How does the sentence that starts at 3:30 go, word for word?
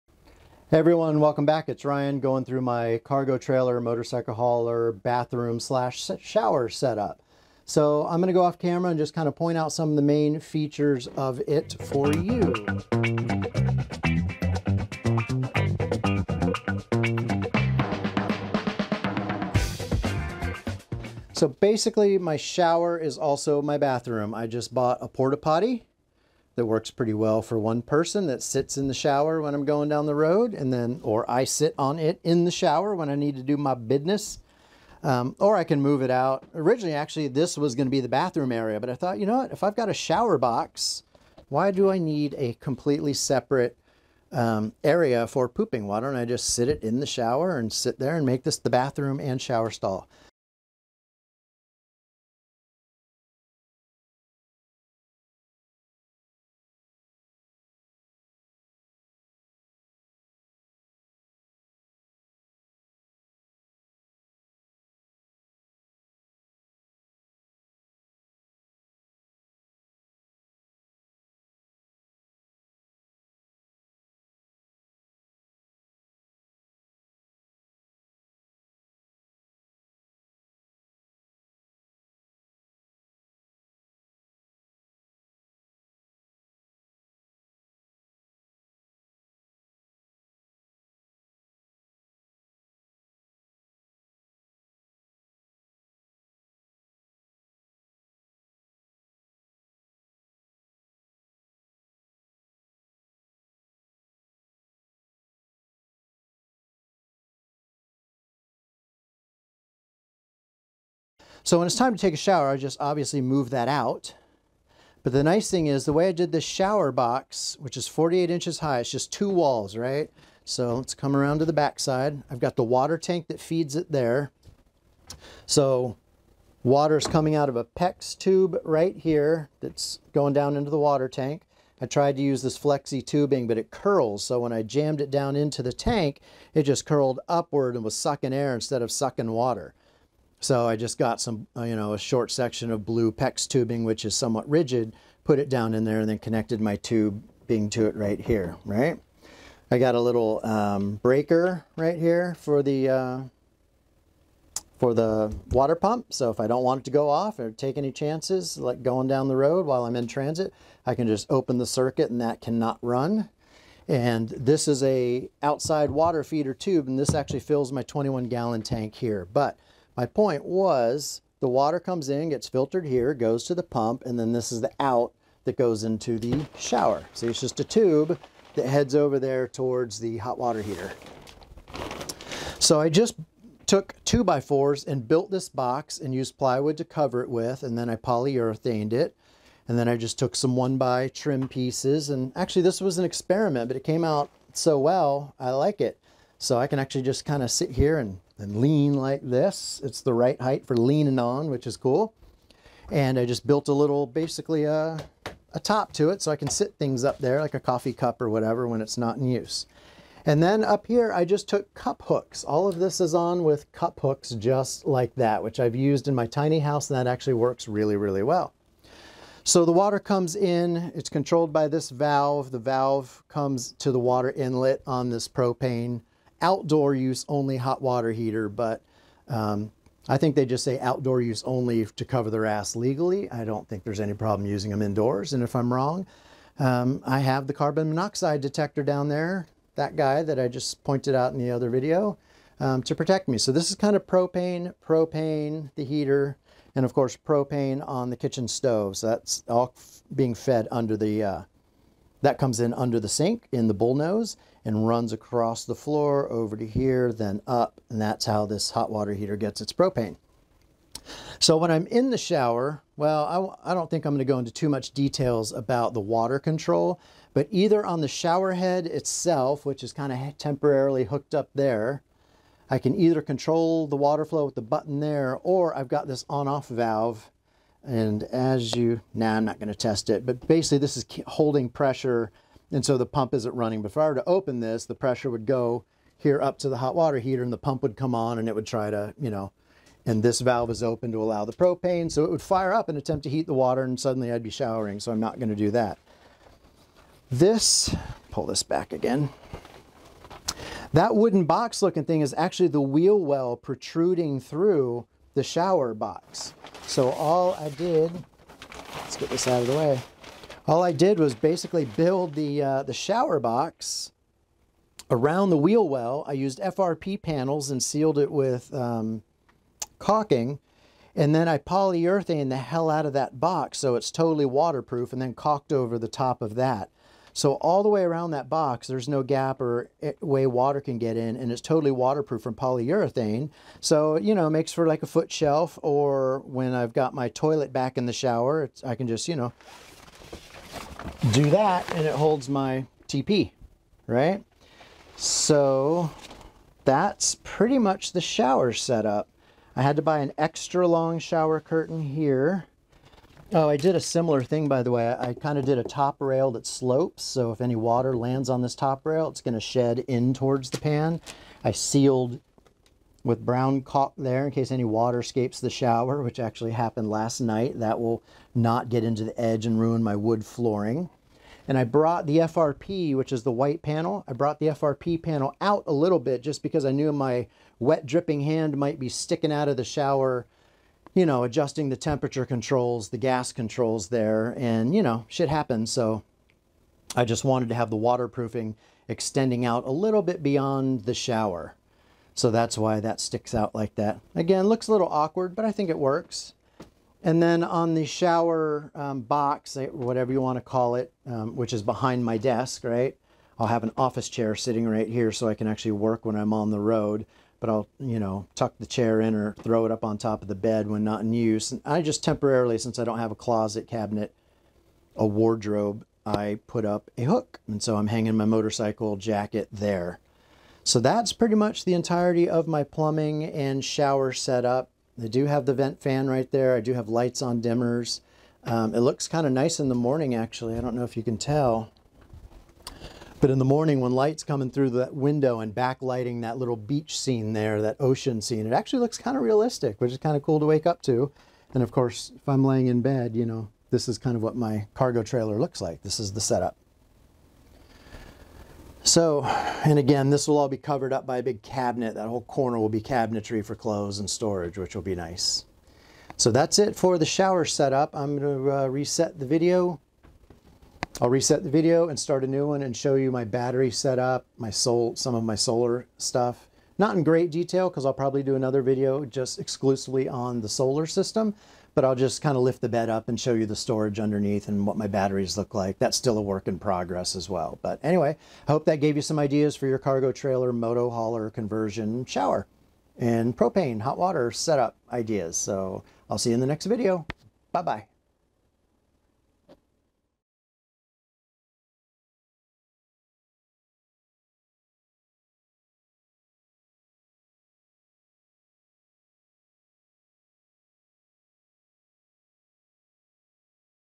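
And then up here, I just took cup hooks.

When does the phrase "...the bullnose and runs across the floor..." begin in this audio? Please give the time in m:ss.
4:13.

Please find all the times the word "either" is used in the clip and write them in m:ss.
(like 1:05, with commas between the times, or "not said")
4:27, 4:32.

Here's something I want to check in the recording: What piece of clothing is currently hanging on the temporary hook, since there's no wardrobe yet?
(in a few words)
Motorcycle jacket.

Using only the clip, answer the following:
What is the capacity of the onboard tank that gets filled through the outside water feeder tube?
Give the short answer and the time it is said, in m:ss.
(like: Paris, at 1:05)
21 gallons, at 2:47.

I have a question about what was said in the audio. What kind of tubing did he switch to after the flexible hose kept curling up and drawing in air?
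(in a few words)
blue PEX tubing.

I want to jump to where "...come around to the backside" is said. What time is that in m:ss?
2:00.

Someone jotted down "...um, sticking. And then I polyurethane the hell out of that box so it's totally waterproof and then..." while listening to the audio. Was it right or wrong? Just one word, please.
wrong.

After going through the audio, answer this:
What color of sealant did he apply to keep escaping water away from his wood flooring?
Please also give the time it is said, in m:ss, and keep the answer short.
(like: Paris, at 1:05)
Brown, at 6:03.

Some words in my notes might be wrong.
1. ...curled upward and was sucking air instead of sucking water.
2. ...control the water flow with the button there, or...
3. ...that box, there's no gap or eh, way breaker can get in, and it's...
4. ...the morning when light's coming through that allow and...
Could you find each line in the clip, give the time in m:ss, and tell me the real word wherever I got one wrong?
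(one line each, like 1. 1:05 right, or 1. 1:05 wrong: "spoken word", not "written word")
1. 2:16 right
2. 4:33 right
3. 5:28 wrong: "water", not "breaker"
4. 7:13 wrong: "window", not "allow".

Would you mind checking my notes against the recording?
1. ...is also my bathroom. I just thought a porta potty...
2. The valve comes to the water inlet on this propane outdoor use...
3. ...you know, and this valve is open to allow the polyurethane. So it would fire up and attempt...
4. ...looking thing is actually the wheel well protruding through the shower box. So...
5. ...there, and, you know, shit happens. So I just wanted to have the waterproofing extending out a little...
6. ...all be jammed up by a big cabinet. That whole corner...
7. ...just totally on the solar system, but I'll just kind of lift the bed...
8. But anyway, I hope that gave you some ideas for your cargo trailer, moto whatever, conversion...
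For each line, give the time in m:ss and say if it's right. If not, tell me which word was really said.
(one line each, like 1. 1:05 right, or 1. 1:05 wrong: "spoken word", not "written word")
1. 0:22 wrong: "bought", not "thought"
2. 3:42 right
3. 4:49 wrong: "propane", not "polyurethane"
4. 5:01 right
5. 6:24 right
6. 7:30 wrong: "covered", not "jammed"
7. 7:49 wrong: "exclusively", not "totally"
8. 7:57 wrong: "hauler", not "whatever".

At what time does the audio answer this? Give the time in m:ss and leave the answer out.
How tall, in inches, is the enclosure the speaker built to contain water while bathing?
1:57.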